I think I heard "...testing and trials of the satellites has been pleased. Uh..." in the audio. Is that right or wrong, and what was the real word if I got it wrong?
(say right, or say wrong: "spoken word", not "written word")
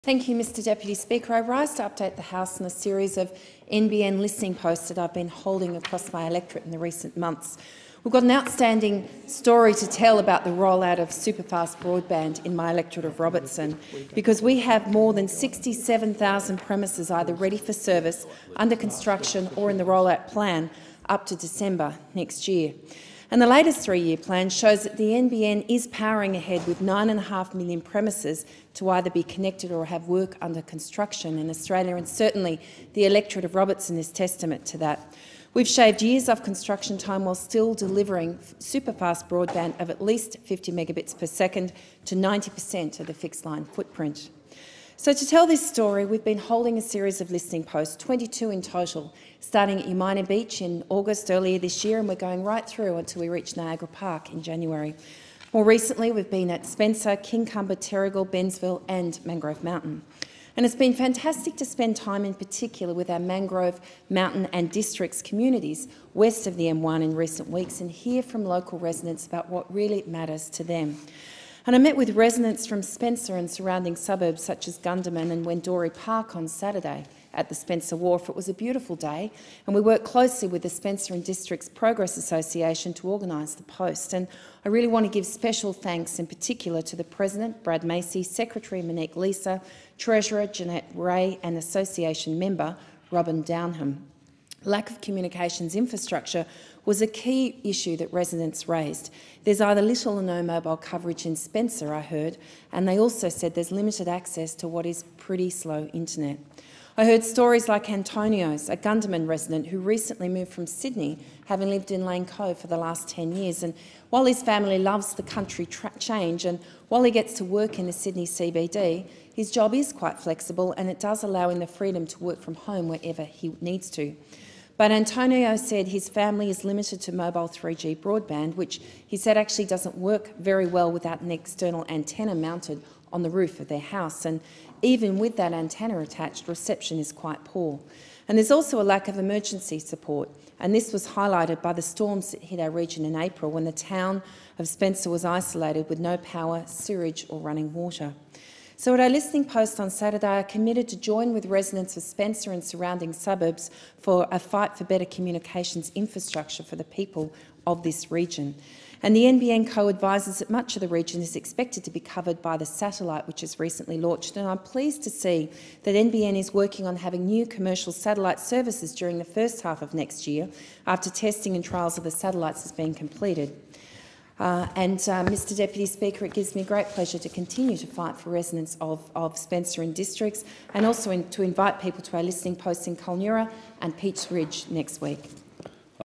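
wrong: "completed", not "pleased".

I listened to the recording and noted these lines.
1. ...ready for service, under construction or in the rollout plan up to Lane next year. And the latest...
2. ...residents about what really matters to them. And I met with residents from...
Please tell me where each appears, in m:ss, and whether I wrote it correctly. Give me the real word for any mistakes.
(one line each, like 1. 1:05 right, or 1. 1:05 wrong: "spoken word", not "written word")
1. 0:17 wrong: "December", not "Lane"
2. 1:08 right.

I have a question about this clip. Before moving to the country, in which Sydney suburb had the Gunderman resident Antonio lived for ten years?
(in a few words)
Lane Cove.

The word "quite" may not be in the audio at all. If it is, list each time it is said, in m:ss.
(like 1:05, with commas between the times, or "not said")
1:59, 2:17.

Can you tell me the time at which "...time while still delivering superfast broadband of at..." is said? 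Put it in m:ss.
0:36.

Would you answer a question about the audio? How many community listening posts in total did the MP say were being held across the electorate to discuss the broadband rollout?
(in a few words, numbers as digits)
22.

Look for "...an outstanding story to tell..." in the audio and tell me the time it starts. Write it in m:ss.
0:08.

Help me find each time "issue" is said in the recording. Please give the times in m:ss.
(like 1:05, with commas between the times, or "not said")
1:37.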